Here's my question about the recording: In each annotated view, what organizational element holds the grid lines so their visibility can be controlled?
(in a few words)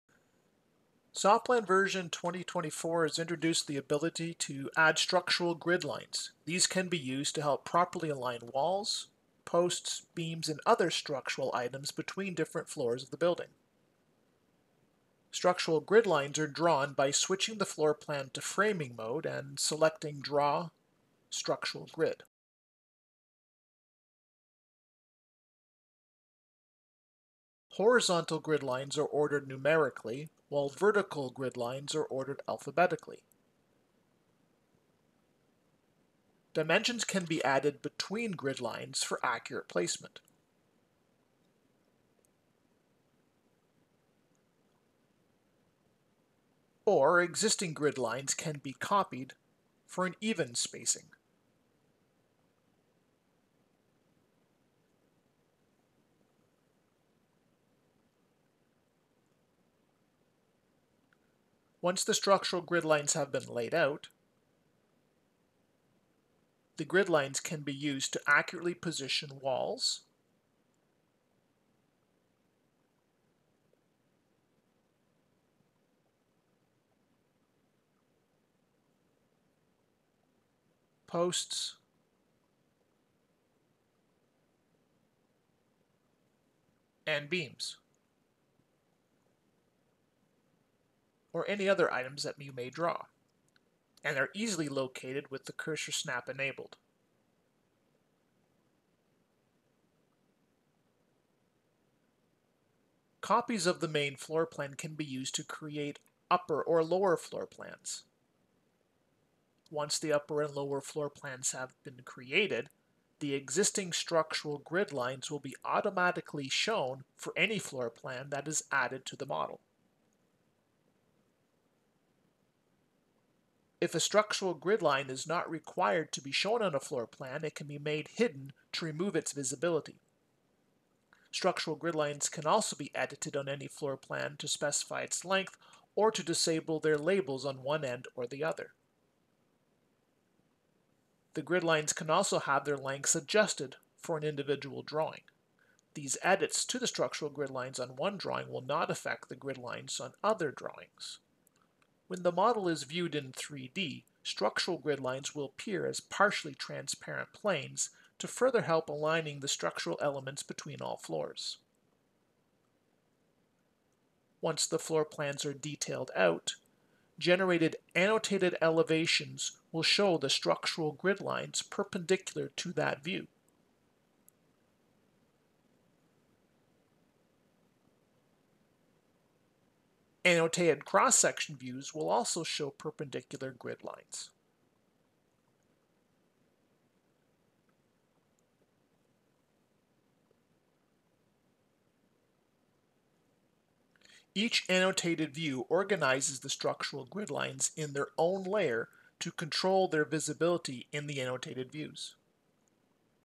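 Their own layer.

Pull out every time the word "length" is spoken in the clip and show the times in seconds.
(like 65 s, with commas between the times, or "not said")
135 s, 142 s.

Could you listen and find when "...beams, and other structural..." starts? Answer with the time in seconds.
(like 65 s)
10 s.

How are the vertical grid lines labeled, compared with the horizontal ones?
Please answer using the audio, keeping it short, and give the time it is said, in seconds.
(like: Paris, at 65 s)
Alphabetically, at 32 s.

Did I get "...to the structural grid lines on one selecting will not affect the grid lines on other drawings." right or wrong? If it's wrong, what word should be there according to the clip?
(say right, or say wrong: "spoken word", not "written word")
wrong: "drawing", not "selecting".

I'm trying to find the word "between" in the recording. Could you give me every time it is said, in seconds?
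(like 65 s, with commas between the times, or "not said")
11 s, 37 s, 160 s.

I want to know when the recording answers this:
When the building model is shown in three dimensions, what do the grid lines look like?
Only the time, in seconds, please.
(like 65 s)
156 s.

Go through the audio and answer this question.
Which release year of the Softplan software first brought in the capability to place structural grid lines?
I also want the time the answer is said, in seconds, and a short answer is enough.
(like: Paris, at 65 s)
2024, at 2 s.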